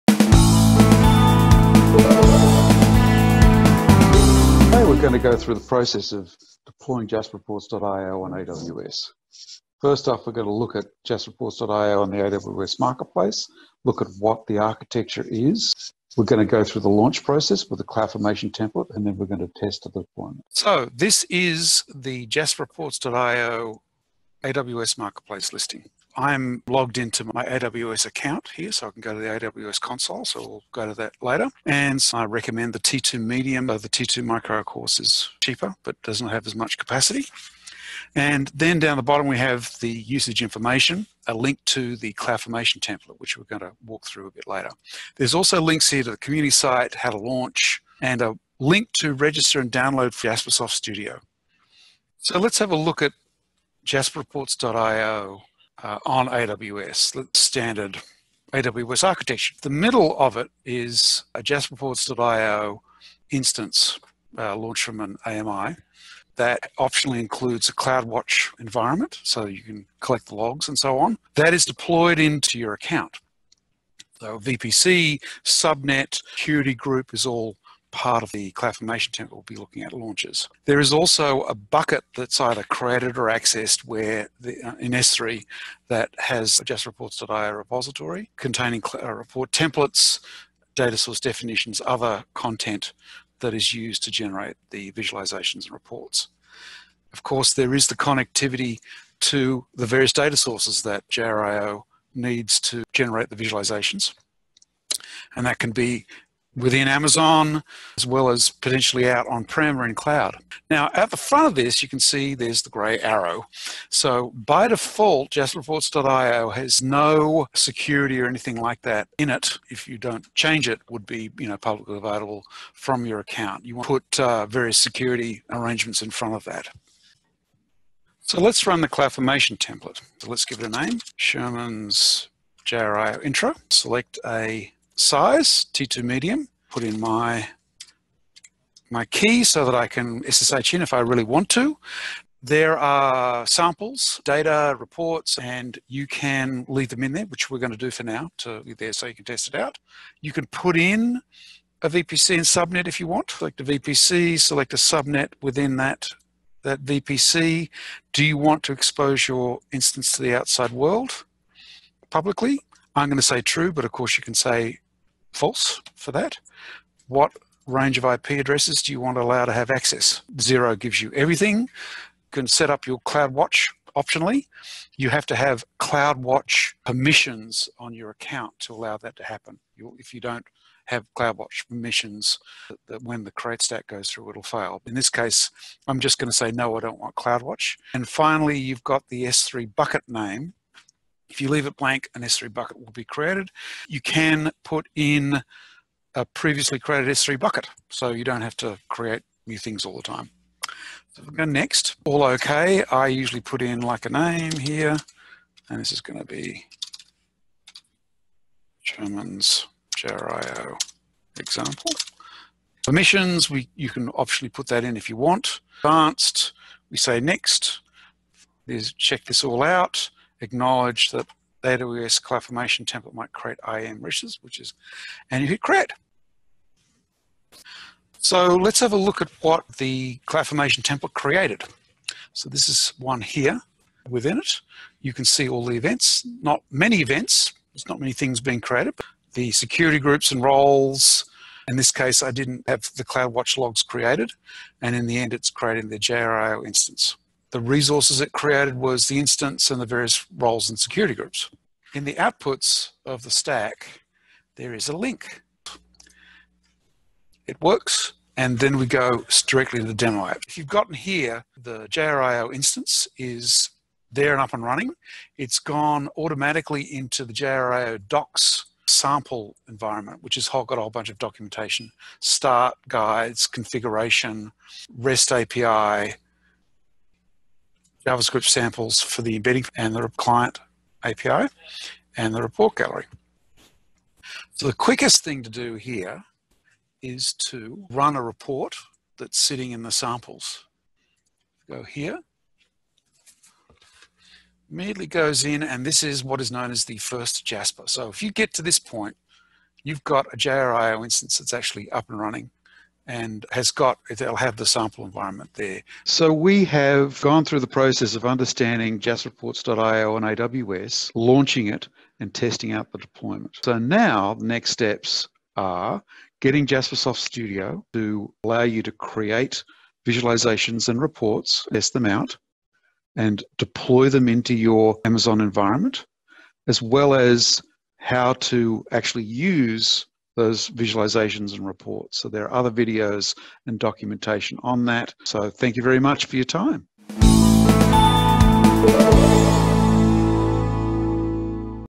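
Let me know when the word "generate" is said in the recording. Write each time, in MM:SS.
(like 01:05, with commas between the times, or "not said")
01:34, 01:42.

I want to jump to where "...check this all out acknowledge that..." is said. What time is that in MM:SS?
03:38.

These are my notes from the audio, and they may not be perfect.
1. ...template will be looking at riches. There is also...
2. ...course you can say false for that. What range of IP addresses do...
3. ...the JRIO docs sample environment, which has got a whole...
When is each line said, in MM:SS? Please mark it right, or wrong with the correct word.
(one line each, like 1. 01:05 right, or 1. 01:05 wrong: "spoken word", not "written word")
1. 01:19 wrong: "launches", not "riches"
2. 02:43 right
3. 04:27 right.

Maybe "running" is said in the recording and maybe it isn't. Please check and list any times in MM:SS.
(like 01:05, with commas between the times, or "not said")
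04:24, 05:02.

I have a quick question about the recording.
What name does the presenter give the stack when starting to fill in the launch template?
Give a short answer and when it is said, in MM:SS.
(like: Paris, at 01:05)
Sherman's JRI intro, at 02:11.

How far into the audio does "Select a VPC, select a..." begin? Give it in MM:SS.
02:33.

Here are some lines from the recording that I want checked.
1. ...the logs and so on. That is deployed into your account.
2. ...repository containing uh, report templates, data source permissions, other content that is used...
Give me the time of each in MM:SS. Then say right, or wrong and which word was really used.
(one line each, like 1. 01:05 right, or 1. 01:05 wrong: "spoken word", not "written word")
1. 01:10 right
2. 01:27 wrong: "definitions", not "permissions".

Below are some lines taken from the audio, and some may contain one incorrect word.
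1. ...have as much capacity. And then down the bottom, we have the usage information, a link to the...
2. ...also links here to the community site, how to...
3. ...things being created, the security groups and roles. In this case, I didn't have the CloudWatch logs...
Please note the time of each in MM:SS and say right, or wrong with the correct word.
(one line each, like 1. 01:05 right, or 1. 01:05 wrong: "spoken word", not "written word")
1. 00:36 right
2. 00:45 right
3. 03:58 right.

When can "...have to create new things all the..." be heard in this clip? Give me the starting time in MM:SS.
03:18.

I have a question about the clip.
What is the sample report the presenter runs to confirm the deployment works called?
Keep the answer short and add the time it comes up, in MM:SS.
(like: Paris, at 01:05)
first Jasper, at 04:56.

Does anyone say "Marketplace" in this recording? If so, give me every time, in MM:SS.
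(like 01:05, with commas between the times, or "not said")
00:12, 00:24.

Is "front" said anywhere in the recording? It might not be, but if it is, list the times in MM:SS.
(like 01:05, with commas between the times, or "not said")
01:51, 02:06.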